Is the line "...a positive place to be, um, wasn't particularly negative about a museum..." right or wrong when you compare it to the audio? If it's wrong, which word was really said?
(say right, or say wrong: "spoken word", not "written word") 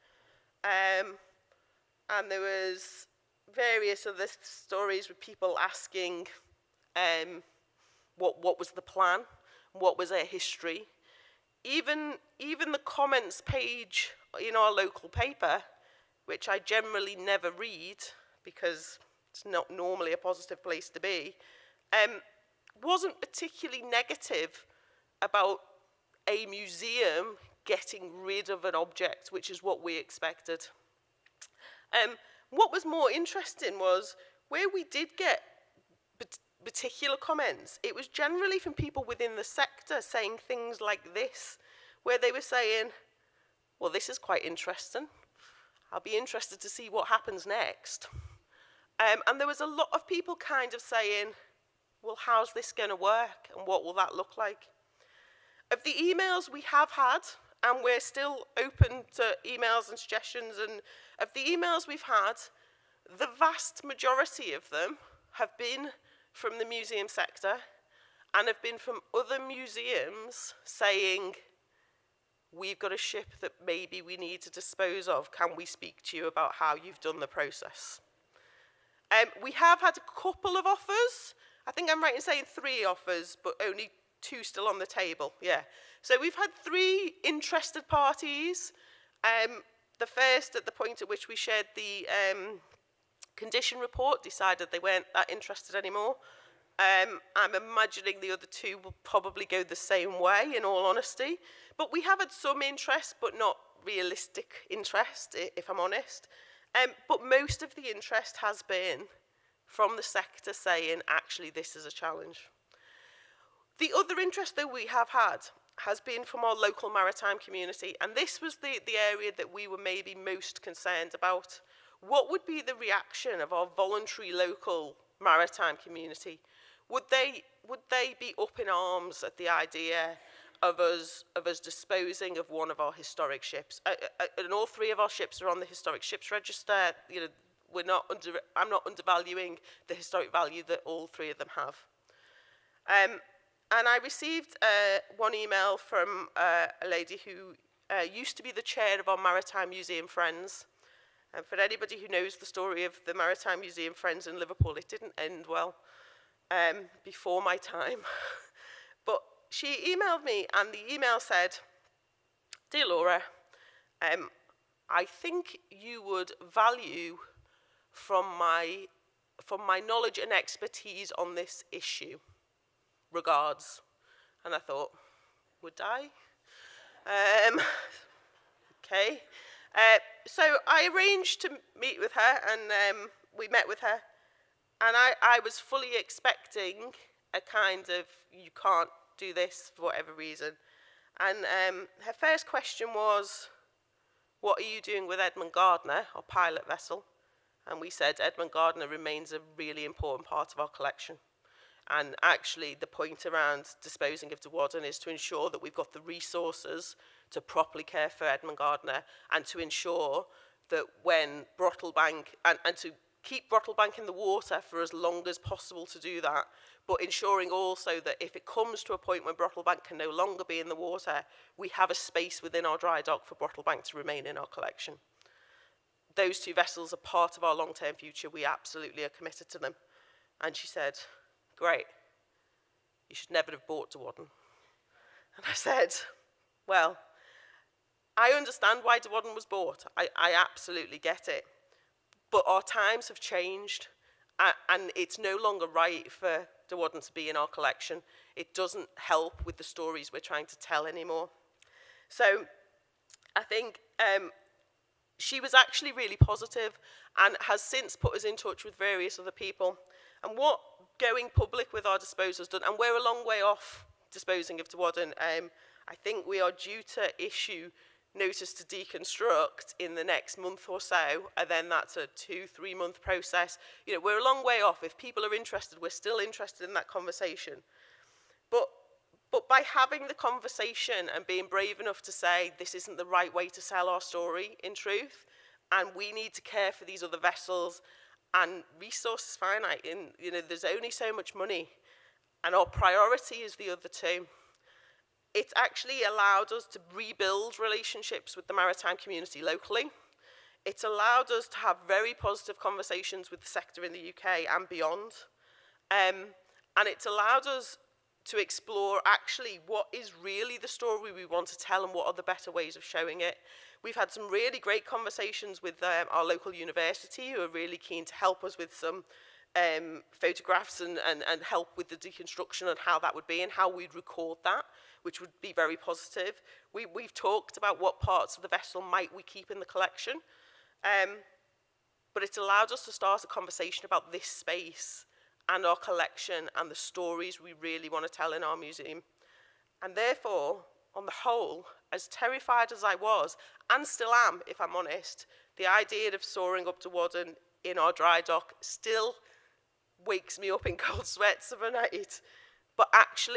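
right.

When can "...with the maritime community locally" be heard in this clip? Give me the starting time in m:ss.
4:58.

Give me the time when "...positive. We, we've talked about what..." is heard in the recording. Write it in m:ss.
5:25.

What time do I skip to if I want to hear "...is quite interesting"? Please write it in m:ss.
0:44.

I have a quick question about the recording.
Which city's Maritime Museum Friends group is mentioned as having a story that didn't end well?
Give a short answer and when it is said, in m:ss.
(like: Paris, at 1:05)
Liverpool, at 2:34.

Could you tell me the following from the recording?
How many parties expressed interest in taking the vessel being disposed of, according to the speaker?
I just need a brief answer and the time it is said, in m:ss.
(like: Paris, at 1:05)
3, at 1:26.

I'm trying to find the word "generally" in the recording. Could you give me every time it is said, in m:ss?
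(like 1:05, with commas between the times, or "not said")
0:16, 0:38.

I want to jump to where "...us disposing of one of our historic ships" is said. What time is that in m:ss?
2:11.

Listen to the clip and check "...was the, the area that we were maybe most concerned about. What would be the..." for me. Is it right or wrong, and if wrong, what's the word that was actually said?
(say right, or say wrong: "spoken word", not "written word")
right.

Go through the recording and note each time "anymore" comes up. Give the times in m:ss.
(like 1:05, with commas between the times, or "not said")
1:35, 4:10.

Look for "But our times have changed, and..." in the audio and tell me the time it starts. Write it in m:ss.
4:02.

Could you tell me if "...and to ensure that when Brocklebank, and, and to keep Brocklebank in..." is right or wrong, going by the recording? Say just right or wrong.
right.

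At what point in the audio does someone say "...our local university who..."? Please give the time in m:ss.
5:16.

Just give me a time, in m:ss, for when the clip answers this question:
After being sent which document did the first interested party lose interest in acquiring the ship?
1:33.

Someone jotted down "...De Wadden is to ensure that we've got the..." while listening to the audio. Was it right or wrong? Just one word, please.
right.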